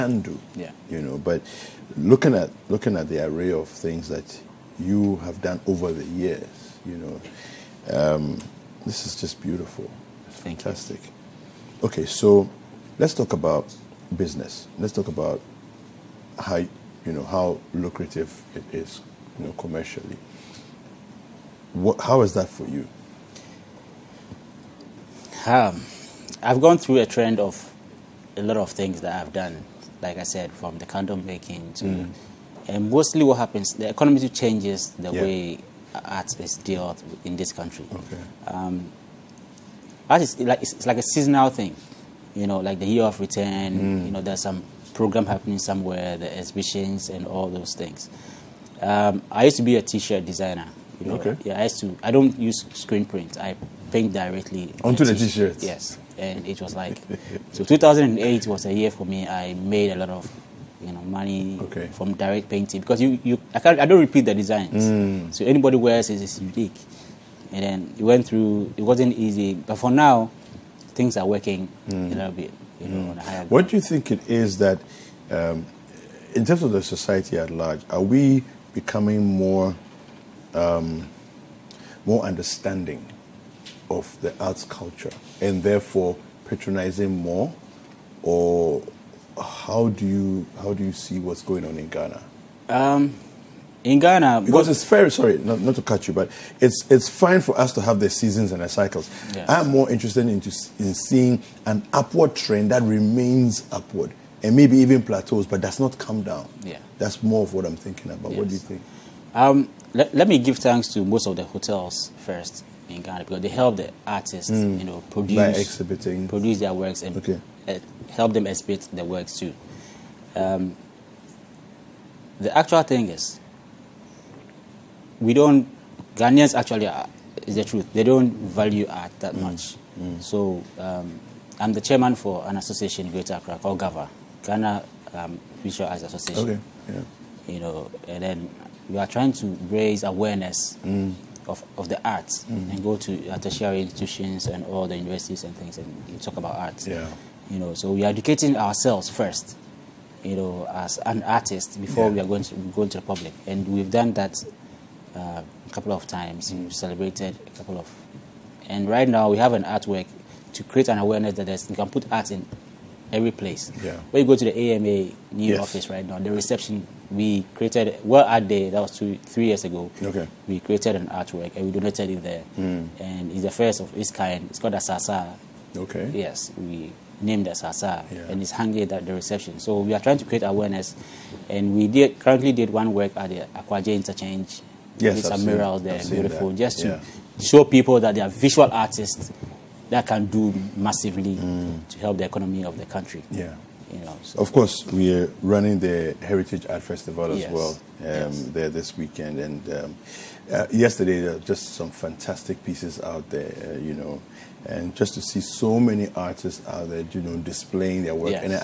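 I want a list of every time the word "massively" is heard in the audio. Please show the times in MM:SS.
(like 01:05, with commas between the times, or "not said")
03:10.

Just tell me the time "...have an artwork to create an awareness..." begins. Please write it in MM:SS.
02:39.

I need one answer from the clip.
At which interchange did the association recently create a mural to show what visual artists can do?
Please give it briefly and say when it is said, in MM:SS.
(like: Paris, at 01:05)
Aquaje interchange, at 03:03.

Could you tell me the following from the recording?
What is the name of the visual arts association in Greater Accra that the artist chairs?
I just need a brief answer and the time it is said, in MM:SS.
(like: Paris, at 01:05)
GAVA, at 02:13.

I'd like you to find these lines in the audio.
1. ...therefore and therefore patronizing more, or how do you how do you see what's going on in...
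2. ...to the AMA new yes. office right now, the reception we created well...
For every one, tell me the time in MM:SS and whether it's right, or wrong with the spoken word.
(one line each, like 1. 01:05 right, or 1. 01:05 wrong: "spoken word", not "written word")
1. 01:24 wrong: "culture", not "therefore"
2. 02:44 right.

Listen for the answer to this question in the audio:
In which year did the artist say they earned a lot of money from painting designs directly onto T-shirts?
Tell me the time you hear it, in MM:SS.
00:57.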